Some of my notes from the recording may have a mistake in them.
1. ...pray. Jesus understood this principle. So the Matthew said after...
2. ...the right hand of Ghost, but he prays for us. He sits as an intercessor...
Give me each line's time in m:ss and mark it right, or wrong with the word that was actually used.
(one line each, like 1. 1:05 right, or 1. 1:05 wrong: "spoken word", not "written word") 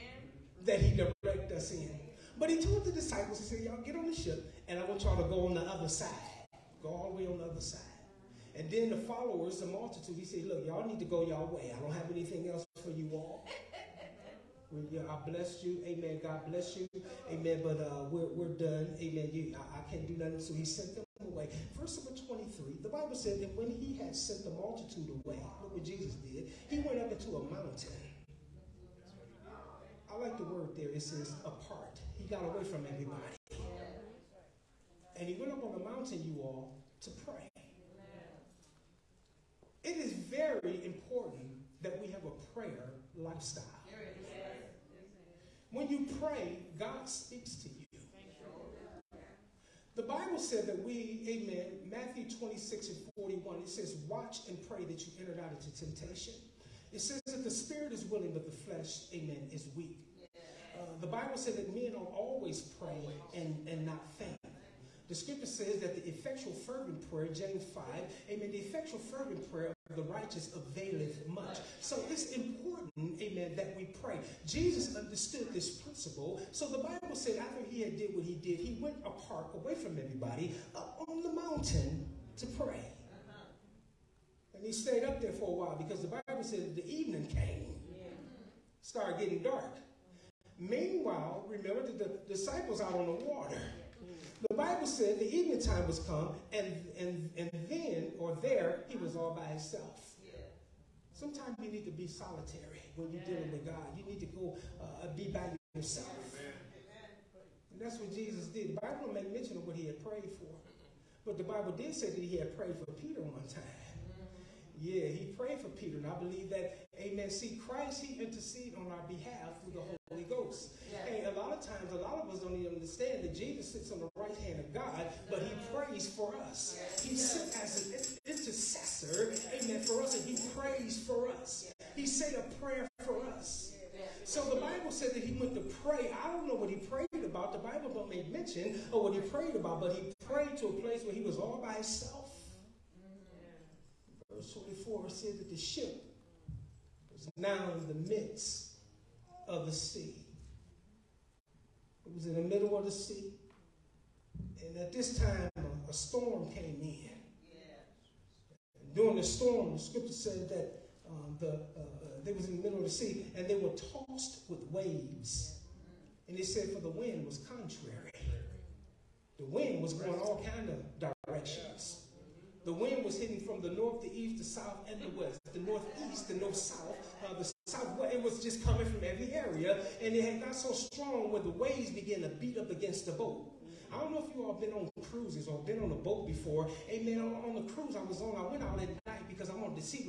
1. 1:14 wrong: "Bible", not "Matthew"
2. 2:04 wrong: "God", not "Ghost".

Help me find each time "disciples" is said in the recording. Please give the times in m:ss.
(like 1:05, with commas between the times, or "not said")
0:02, 1:32.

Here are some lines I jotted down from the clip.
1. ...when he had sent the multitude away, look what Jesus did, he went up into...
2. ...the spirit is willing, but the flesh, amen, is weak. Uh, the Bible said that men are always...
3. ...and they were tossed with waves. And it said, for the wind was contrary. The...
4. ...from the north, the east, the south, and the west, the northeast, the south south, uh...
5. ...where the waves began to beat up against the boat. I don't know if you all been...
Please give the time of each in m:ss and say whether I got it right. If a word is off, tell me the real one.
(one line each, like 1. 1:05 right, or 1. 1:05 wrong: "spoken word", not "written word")
1. 0:23 right
2. 0:57 right
3. 2:43 right
4. 2:53 wrong: "north", not "south"
5. 3:01 right.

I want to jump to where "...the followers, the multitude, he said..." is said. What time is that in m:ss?
0:08.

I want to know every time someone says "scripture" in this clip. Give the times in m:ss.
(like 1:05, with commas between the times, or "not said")
1:05, 2:39.